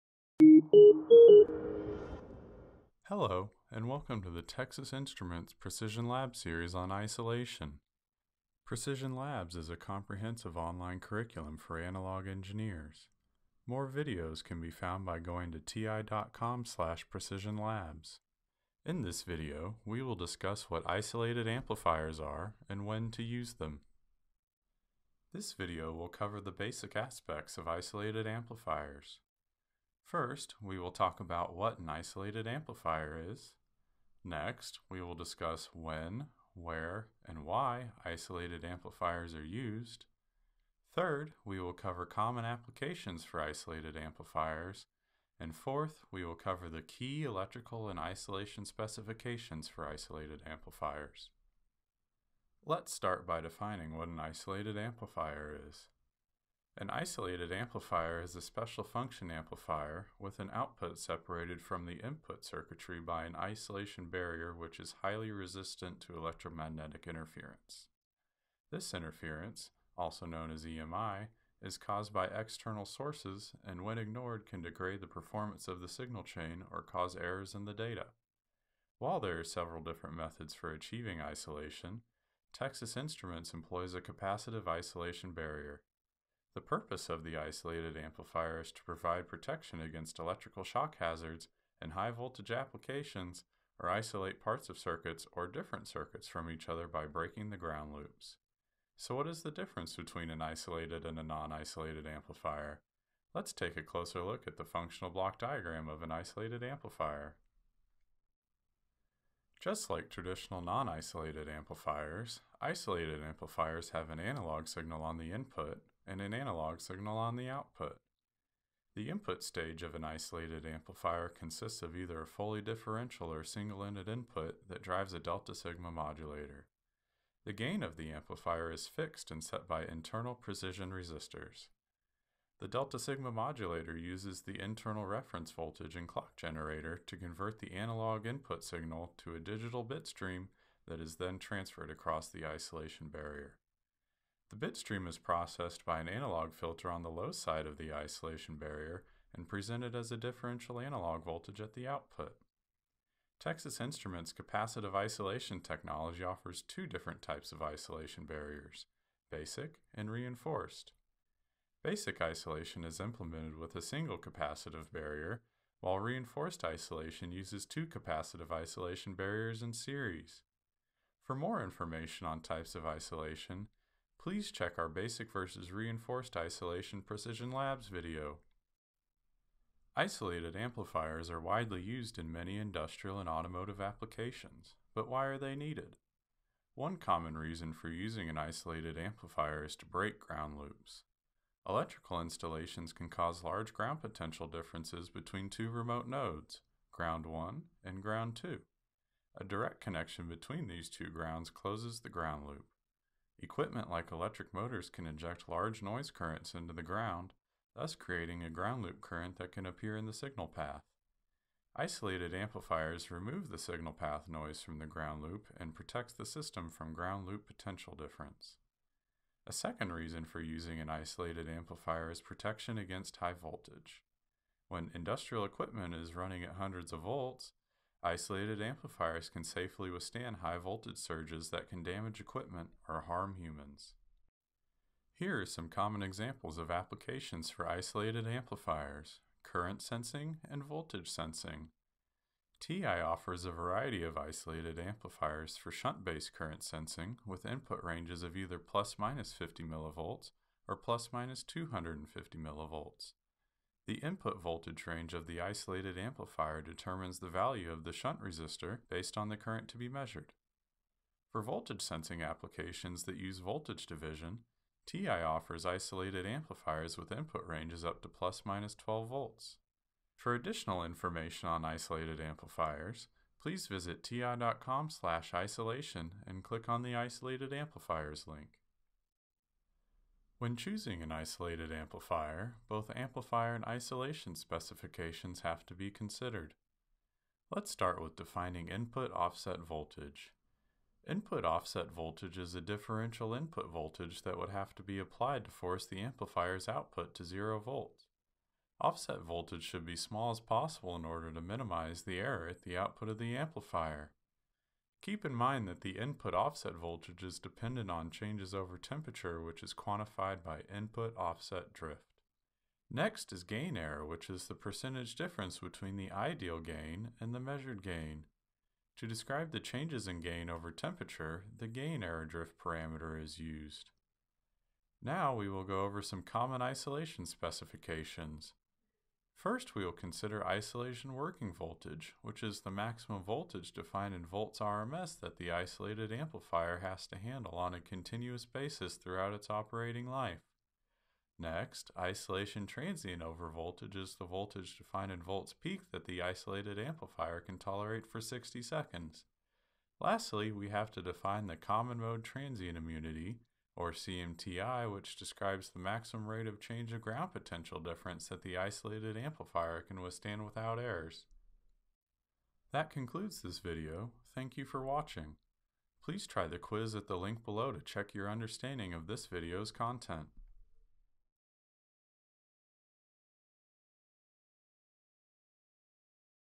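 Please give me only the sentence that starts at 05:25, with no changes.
Now we will go over some common isolation specifications.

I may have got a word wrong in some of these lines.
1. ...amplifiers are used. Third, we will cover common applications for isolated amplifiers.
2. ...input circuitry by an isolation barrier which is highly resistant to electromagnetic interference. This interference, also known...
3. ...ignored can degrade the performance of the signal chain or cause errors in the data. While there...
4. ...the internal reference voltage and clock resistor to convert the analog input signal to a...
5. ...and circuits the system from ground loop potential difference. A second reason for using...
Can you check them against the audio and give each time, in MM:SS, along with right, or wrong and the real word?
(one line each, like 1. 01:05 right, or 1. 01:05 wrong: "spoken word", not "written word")
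1. 00:38 right
2. 01:02 right
3. 01:13 right
4. 02:14 wrong: "generator", not "resistor"
5. 03:35 wrong: "protects", not "circuits".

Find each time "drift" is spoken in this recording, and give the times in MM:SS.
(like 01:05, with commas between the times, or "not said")
05:11, 05:22.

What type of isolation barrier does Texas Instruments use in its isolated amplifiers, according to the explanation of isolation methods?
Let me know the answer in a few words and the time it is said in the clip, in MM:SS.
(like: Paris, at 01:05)
Capacitive isolation barrier, at 01:24.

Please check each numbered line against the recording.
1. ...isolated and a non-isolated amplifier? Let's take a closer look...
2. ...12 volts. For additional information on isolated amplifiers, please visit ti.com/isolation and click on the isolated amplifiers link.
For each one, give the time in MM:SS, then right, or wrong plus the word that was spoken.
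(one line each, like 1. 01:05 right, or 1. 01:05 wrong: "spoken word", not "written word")
1. 01:40 right
2. 04:28 right.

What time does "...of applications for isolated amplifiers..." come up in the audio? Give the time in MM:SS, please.
03:56.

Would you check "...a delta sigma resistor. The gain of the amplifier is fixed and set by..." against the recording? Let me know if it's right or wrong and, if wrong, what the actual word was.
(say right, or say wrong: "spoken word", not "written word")
wrong: "modulator", not "resistor".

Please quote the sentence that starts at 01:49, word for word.
Just like traditional non-isolated amplifiers, isolated amplifiers have an analog signal on the input, and an analog signal on the output.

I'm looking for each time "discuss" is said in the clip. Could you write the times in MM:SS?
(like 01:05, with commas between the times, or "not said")
00:20, 00:35.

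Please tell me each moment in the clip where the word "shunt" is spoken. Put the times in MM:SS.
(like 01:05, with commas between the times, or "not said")
04:05, 04:17.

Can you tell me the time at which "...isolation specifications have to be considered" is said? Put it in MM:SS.
04:43.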